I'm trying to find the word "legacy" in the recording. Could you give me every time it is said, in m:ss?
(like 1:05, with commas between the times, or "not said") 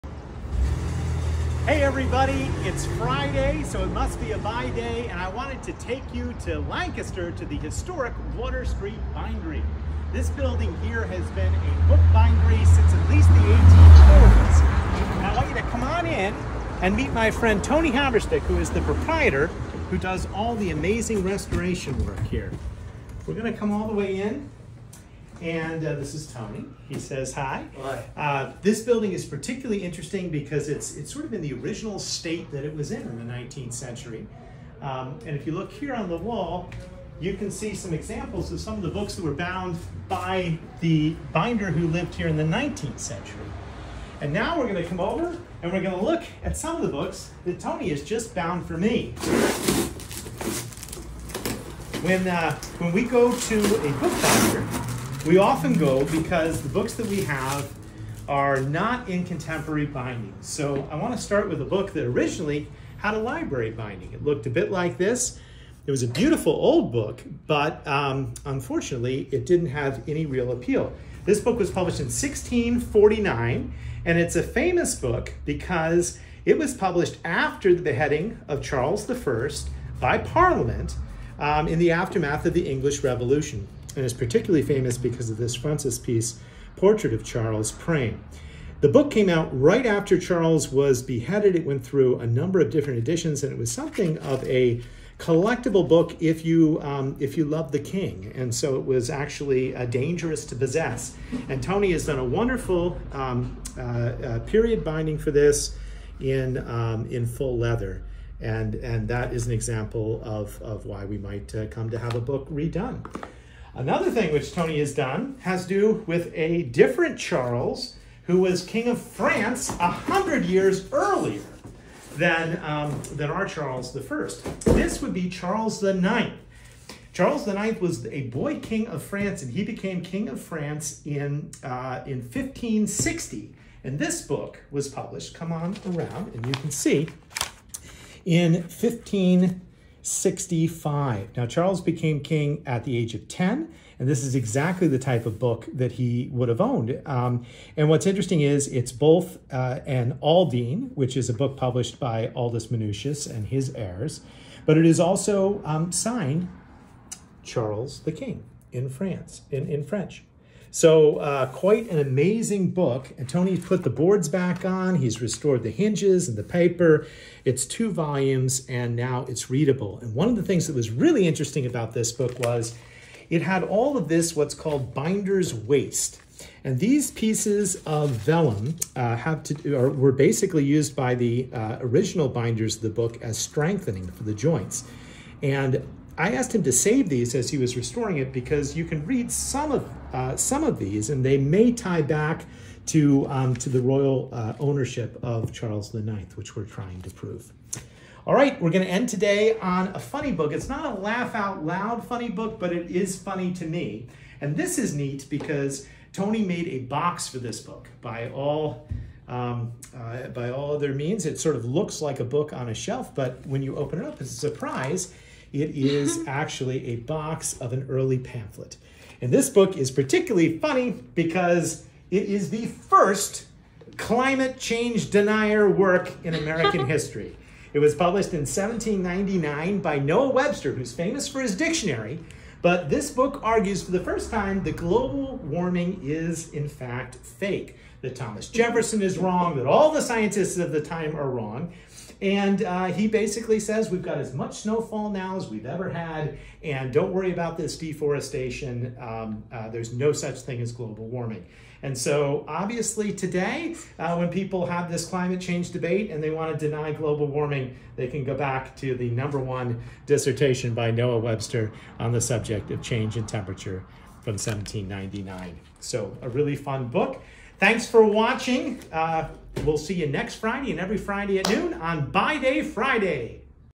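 not said.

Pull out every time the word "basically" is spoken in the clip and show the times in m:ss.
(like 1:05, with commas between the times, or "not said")
3:00, 4:03.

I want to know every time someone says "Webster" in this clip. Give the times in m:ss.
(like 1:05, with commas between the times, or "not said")
3:50, 4:21.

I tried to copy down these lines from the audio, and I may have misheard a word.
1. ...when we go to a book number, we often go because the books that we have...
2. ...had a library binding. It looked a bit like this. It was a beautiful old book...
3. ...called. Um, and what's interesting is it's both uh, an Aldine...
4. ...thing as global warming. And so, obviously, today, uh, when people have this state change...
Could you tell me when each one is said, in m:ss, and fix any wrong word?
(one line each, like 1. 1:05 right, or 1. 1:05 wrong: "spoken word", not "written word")
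1. 0:52 wrong: "binder", not "number"
2. 1:02 right
3. 2:26 wrong: "owned", not "called"
4. 4:10 wrong: "climate", not "state".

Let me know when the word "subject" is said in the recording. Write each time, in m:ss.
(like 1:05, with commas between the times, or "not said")
4:22.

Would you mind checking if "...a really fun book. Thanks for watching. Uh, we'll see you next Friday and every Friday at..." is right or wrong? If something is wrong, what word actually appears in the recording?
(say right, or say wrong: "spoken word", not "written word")
right.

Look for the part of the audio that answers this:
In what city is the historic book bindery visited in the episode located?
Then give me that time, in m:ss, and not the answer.
0:06.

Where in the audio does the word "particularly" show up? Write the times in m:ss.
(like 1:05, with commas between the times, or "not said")
0:29, 1:24, 3:39.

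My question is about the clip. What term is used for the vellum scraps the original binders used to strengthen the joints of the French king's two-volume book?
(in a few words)
binder's waste.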